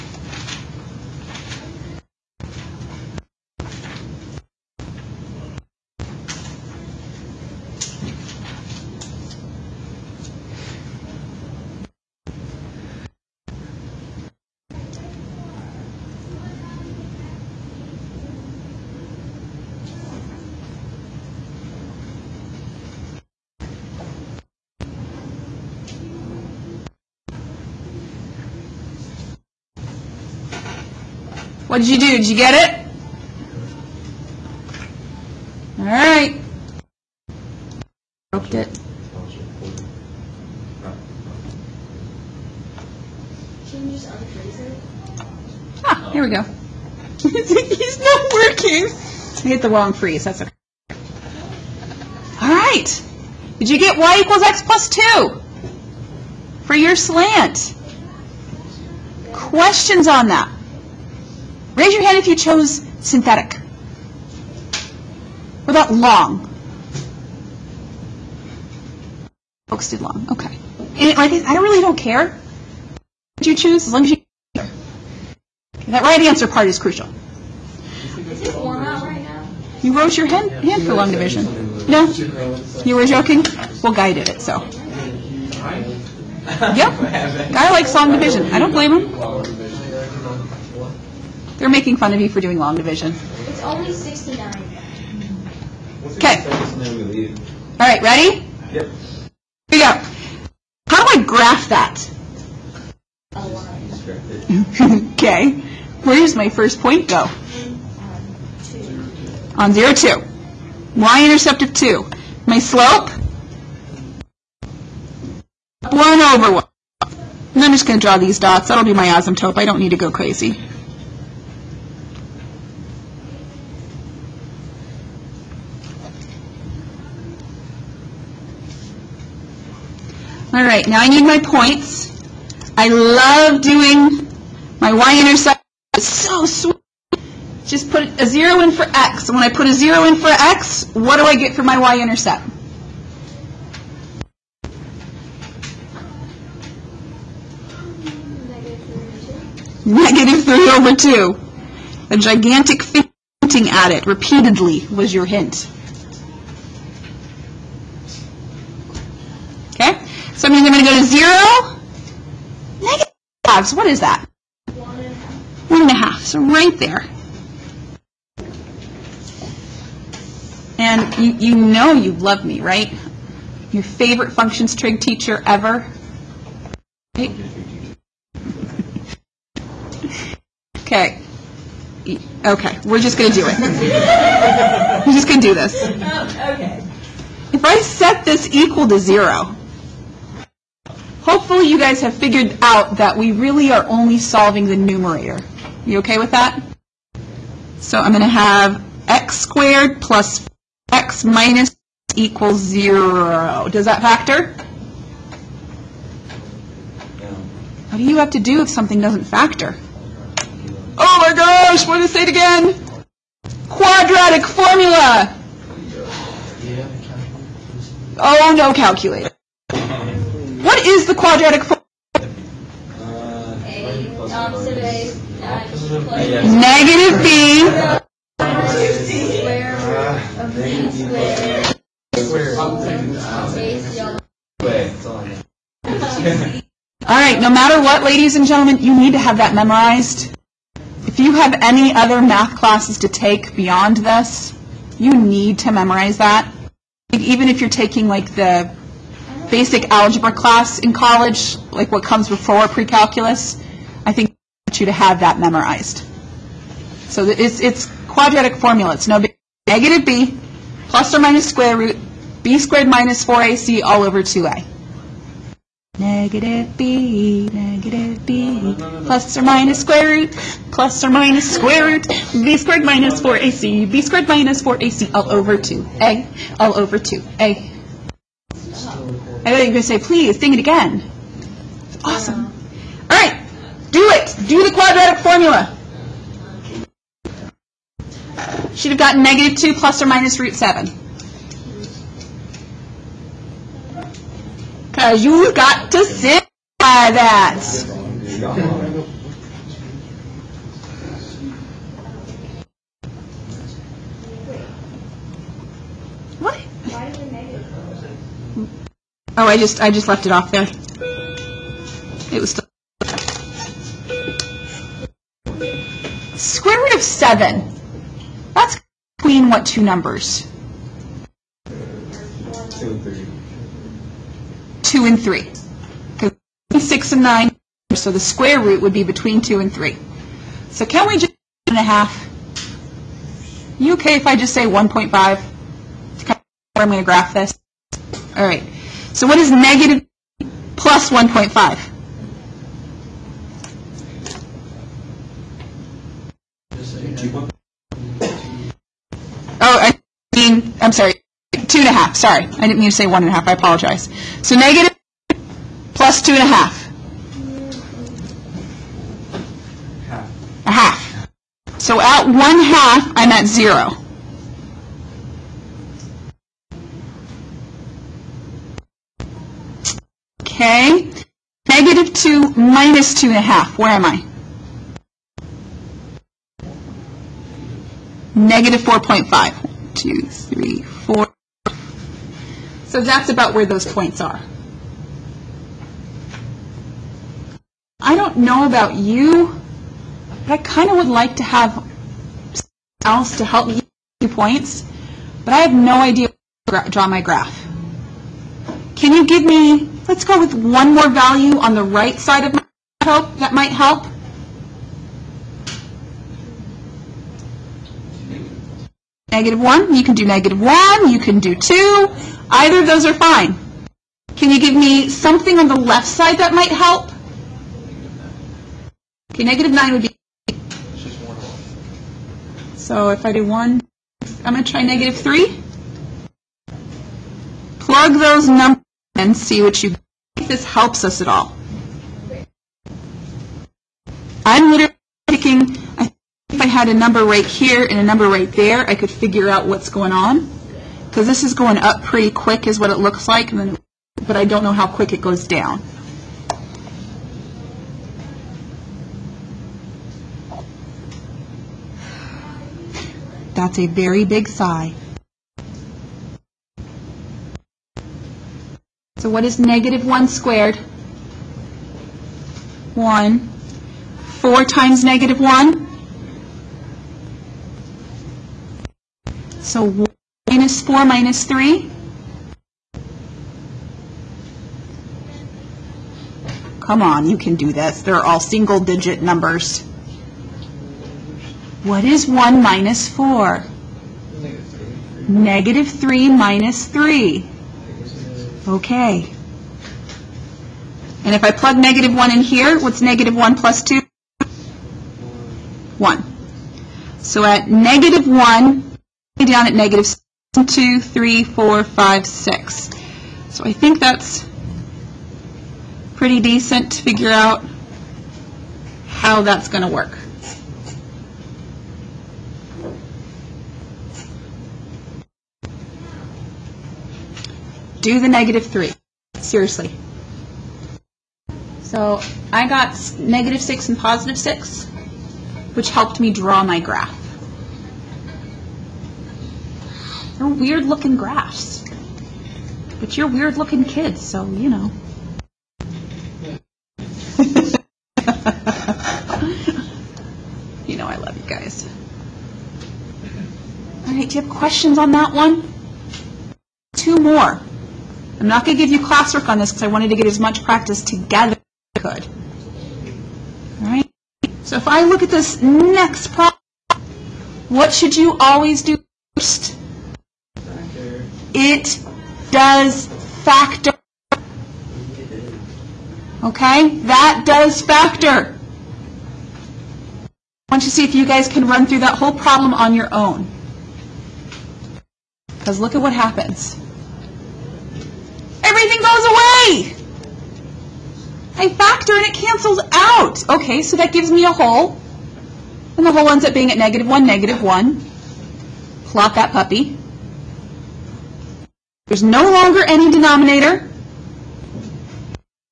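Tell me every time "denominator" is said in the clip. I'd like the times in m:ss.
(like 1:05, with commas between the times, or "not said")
9:53.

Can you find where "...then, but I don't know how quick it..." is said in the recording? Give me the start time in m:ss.
7:23.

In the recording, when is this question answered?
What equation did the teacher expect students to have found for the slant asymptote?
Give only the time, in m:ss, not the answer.
0:53.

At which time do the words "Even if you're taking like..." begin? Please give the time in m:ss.
4:07.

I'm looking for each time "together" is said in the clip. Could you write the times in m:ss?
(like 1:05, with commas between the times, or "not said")
9:11.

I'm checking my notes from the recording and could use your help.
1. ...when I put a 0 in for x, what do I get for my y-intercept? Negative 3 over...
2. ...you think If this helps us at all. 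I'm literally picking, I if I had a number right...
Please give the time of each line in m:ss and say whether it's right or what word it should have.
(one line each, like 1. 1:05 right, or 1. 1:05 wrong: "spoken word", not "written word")
1. 2:19 right
2. 7:09 right.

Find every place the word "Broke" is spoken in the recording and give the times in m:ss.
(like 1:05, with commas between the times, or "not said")
0:38.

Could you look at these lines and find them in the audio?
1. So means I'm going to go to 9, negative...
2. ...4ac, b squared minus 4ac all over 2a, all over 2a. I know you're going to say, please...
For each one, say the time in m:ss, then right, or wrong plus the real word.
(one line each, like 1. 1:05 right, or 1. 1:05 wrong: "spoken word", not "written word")
1. 2:40 wrong: "0", not "9"
2. 4:33 right.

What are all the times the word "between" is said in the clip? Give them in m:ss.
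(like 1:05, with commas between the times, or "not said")
5:19, 5:29.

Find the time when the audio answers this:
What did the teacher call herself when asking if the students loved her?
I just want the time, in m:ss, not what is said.
2:53.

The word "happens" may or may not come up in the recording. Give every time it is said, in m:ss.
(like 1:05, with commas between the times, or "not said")
9:36.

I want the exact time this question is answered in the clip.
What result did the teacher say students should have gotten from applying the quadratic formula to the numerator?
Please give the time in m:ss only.
4:49.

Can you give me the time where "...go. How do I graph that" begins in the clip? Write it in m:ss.
1:39.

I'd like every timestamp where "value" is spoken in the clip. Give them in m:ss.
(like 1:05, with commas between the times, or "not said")
6:41.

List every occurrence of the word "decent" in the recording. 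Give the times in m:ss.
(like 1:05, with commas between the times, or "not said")
8:26.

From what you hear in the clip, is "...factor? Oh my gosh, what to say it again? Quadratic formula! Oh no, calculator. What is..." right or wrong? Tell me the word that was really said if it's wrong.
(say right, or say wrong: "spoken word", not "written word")
right.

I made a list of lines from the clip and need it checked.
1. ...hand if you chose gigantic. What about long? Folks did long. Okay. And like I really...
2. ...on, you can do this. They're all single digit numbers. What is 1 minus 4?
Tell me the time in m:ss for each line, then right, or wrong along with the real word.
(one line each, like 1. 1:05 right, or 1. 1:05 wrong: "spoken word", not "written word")
1. 1:02 wrong: "synthetic", not "gigantic"
2. 7:57 right.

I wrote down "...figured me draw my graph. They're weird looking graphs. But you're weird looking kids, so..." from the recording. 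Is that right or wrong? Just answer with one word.
wrong.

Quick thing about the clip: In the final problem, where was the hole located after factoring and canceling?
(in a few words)
(-1, -1).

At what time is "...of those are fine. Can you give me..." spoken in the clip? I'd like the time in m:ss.
6:52.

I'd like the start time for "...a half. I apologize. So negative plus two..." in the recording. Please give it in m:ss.
5:53.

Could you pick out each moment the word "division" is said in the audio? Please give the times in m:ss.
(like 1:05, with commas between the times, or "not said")
1:21, 1:28, 1:32.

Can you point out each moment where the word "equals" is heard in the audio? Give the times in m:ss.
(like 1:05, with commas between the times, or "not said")
0:54, 3:08, 3:22.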